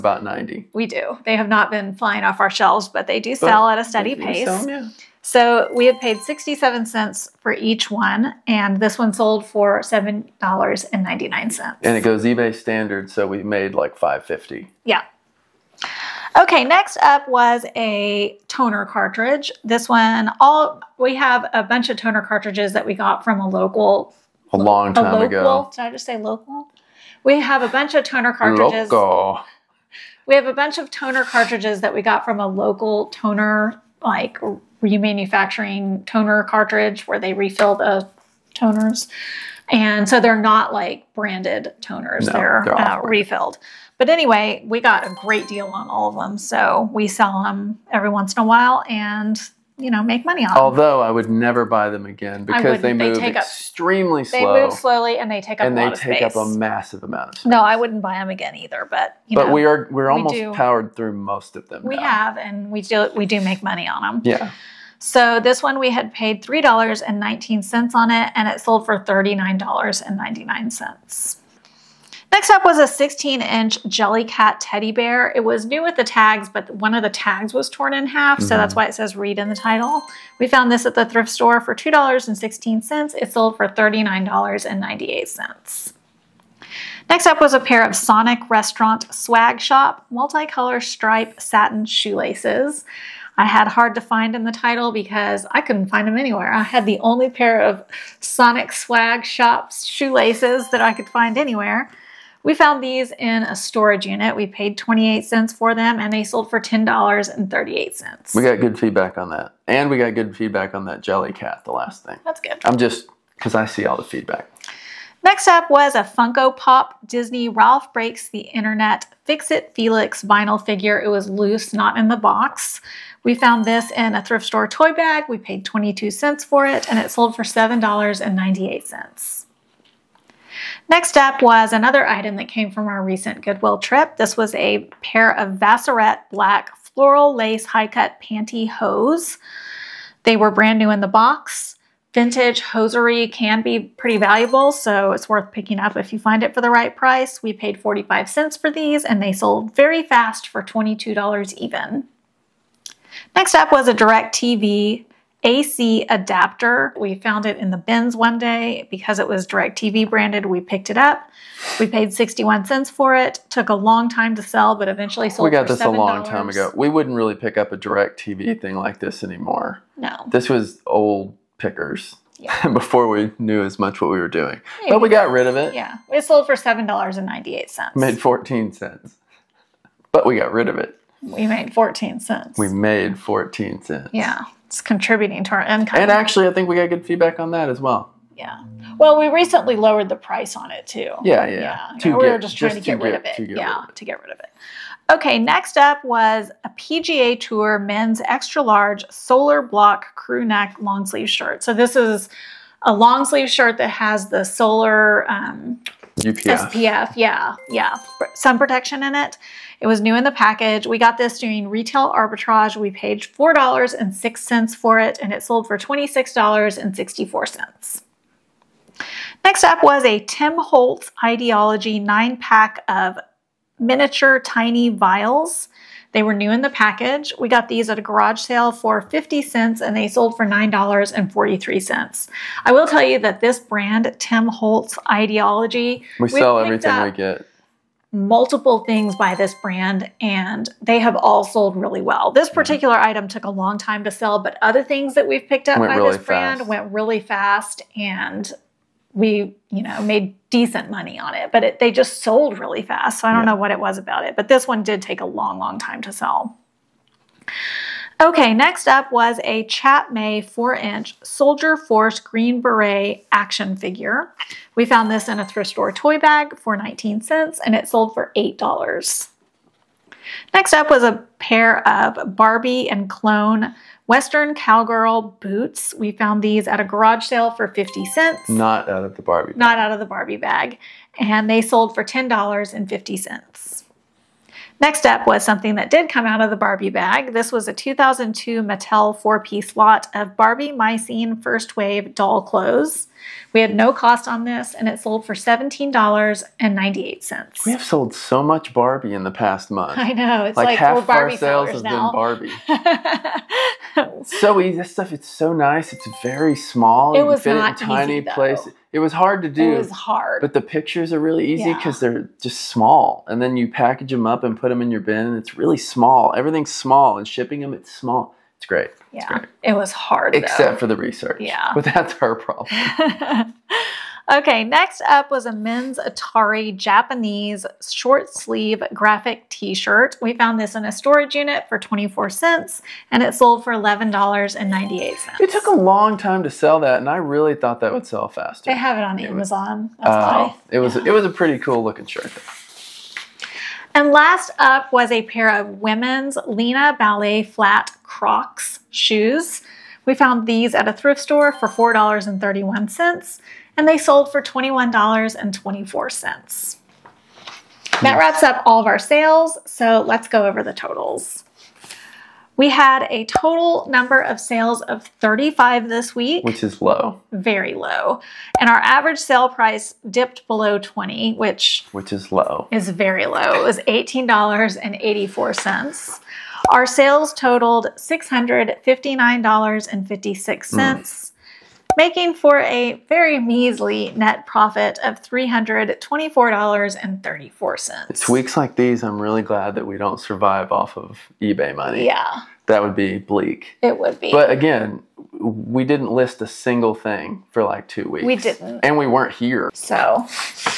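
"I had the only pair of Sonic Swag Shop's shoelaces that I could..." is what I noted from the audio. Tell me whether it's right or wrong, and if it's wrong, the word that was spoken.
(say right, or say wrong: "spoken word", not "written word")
right.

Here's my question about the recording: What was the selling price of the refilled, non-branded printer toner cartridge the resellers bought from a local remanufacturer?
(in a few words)
$39.99.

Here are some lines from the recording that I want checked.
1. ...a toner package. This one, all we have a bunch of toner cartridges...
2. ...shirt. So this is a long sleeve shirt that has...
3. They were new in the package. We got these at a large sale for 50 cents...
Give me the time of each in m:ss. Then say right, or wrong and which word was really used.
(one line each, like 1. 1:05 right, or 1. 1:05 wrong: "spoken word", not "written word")
1. 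0:17 wrong: "cartridge", not "package"
2. 3:21 right
3. 3:46 wrong: "garage", not "large".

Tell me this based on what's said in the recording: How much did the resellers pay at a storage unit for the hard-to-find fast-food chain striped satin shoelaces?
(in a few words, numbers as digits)
28 cents.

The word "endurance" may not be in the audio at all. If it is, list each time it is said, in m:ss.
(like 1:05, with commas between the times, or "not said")
not said.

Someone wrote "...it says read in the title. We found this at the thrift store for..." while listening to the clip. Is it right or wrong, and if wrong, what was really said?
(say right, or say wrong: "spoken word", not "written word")
right.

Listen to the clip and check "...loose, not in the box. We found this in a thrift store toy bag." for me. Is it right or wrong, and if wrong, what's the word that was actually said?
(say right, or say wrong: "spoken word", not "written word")
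right.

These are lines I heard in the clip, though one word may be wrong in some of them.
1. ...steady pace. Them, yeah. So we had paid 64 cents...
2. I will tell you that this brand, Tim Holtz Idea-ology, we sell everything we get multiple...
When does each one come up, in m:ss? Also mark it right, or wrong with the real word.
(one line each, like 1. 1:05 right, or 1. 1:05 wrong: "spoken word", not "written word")
1. 0:03 wrong: "67", not "64"
2. 3:52 right.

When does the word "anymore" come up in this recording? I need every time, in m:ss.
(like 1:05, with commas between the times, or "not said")
2:49.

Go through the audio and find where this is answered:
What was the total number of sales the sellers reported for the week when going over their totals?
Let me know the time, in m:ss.
6:05.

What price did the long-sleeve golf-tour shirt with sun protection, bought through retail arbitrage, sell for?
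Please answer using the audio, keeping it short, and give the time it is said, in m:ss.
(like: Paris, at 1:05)
$26.64, at 3:35.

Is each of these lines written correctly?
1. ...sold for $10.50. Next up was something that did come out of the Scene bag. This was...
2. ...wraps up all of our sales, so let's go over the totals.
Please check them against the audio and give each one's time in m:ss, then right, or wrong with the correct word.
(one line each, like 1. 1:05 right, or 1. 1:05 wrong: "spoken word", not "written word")
1. 4:41 wrong: "Barbie", not "Scene"
2. 5:58 right.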